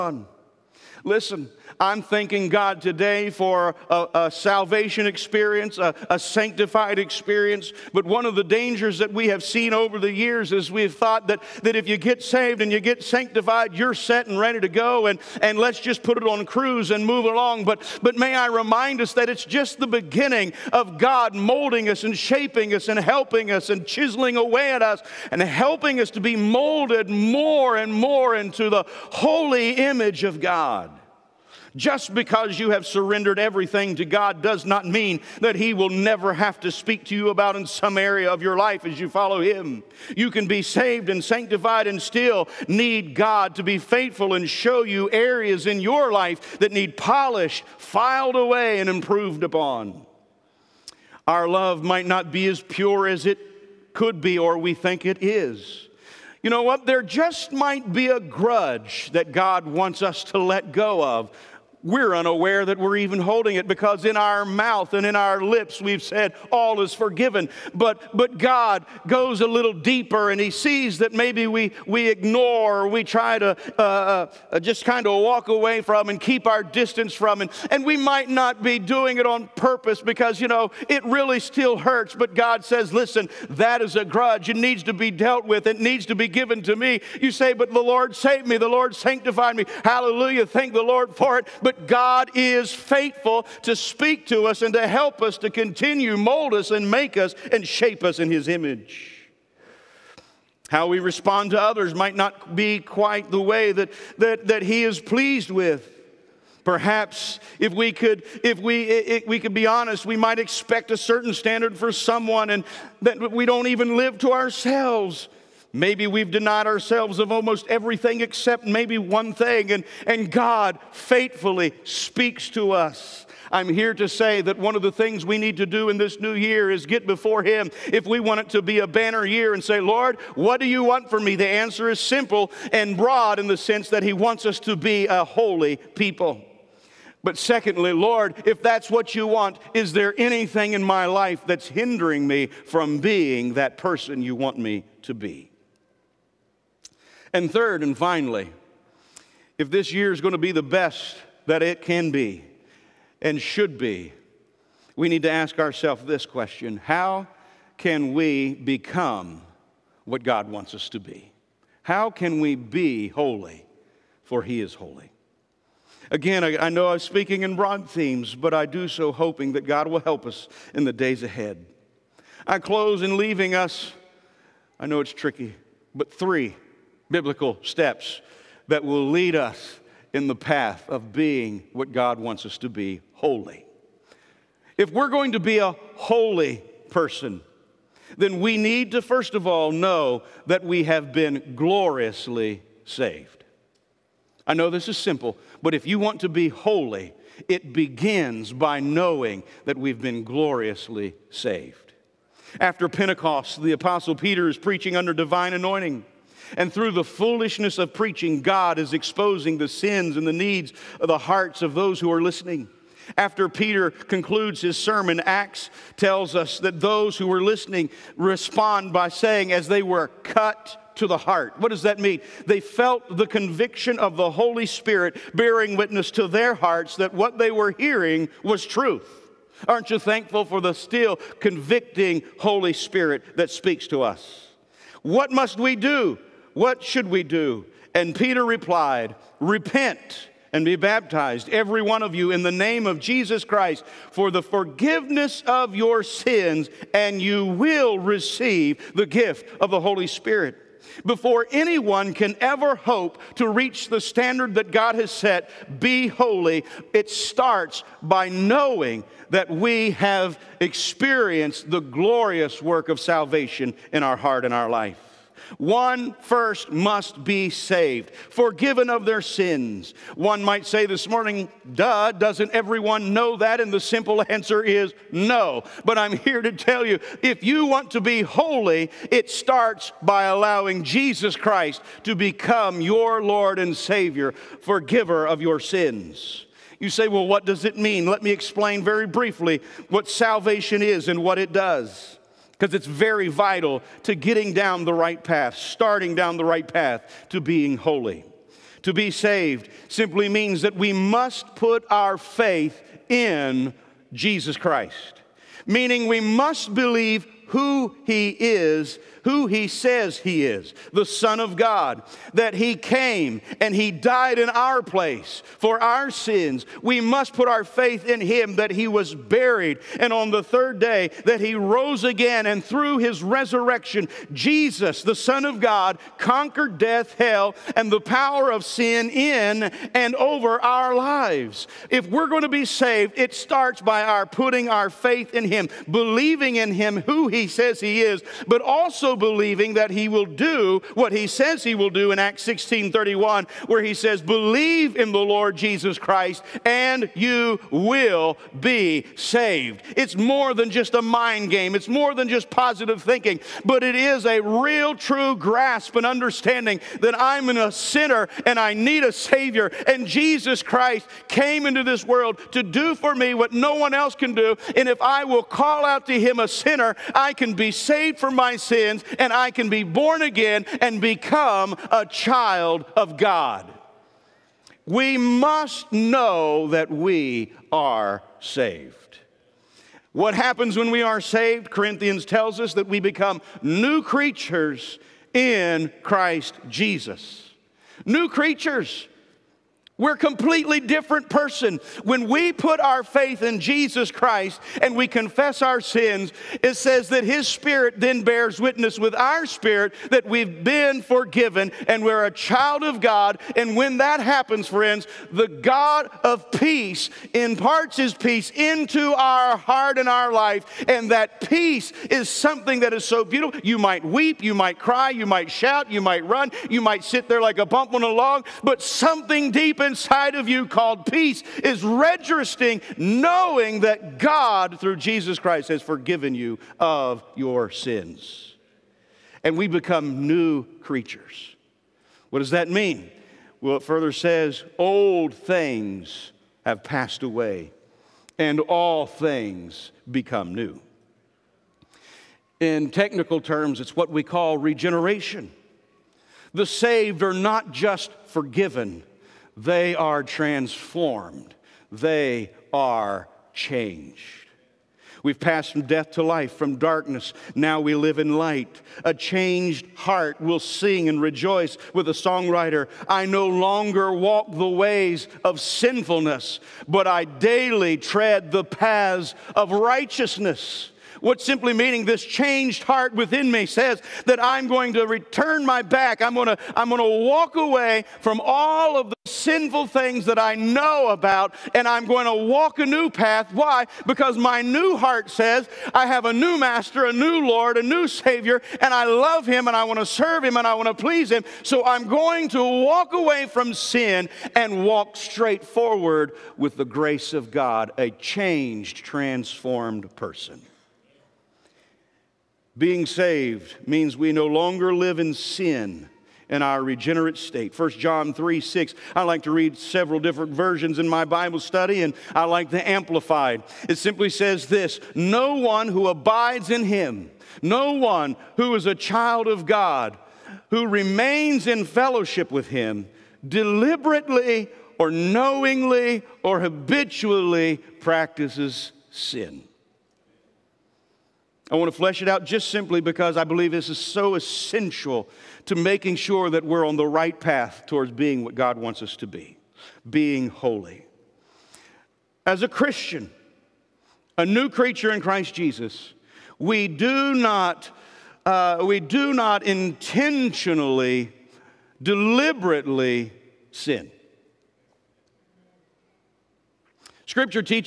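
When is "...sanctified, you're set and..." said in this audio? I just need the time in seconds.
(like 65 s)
13 s.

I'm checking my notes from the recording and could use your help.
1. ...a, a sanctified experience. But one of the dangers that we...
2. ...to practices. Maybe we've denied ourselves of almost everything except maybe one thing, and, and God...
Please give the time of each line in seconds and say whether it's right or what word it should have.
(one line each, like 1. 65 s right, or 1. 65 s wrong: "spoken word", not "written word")
1. 5 s right
2. 114 s wrong: "ourselves", not "practices".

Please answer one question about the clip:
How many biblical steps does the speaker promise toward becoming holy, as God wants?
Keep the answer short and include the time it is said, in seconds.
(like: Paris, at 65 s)
3, at 176 s.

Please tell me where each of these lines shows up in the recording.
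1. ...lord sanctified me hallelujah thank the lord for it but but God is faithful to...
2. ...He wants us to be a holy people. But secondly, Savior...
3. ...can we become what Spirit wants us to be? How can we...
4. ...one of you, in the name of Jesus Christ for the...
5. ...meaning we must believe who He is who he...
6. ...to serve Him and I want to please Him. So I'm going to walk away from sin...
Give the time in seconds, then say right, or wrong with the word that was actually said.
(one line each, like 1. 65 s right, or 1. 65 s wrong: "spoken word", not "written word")
1. 88 s right
2. 134 s wrong: "Lord", not "Savior"
3. 157 s wrong: "God", not "Spirit"
4. 241 s right
5. 305 s right
6. 490 s right.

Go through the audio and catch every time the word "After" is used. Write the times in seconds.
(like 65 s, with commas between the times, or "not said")
202 s, 213 s.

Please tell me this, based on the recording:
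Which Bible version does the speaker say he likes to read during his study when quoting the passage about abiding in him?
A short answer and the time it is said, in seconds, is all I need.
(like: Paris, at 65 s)
Amplified, at 512 s.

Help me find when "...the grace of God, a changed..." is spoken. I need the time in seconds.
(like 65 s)
496 s.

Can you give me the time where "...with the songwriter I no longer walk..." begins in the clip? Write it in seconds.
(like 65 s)
461 s.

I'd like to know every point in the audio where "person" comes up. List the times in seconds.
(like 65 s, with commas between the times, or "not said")
143 s, 186 s, 391 s, 500 s.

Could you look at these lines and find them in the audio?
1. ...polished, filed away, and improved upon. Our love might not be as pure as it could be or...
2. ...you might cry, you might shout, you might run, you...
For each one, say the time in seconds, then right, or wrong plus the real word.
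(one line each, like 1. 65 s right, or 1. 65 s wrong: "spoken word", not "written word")
1. 46 s right
2. 414 s right.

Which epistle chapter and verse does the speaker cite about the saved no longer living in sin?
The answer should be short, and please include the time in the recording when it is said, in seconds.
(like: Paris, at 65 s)
1 John 3:6, at 507 s.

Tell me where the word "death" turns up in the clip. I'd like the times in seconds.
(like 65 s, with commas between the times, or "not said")
326 s, 455 s.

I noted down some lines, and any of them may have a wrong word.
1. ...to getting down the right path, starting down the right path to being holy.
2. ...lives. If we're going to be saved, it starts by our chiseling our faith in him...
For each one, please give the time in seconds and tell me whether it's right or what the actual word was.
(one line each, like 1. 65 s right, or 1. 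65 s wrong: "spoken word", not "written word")
1. 294 s right
2. 330 s wrong: "putting", not "chiseling".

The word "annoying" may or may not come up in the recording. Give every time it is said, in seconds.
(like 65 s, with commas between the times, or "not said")
not said.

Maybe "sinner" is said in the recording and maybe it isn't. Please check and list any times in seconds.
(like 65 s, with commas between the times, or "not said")
357 s, 366 s.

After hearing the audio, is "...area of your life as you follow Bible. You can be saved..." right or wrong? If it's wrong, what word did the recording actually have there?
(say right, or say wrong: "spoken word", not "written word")
wrong: "Him", not "Bible".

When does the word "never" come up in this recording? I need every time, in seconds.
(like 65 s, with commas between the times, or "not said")
35 s.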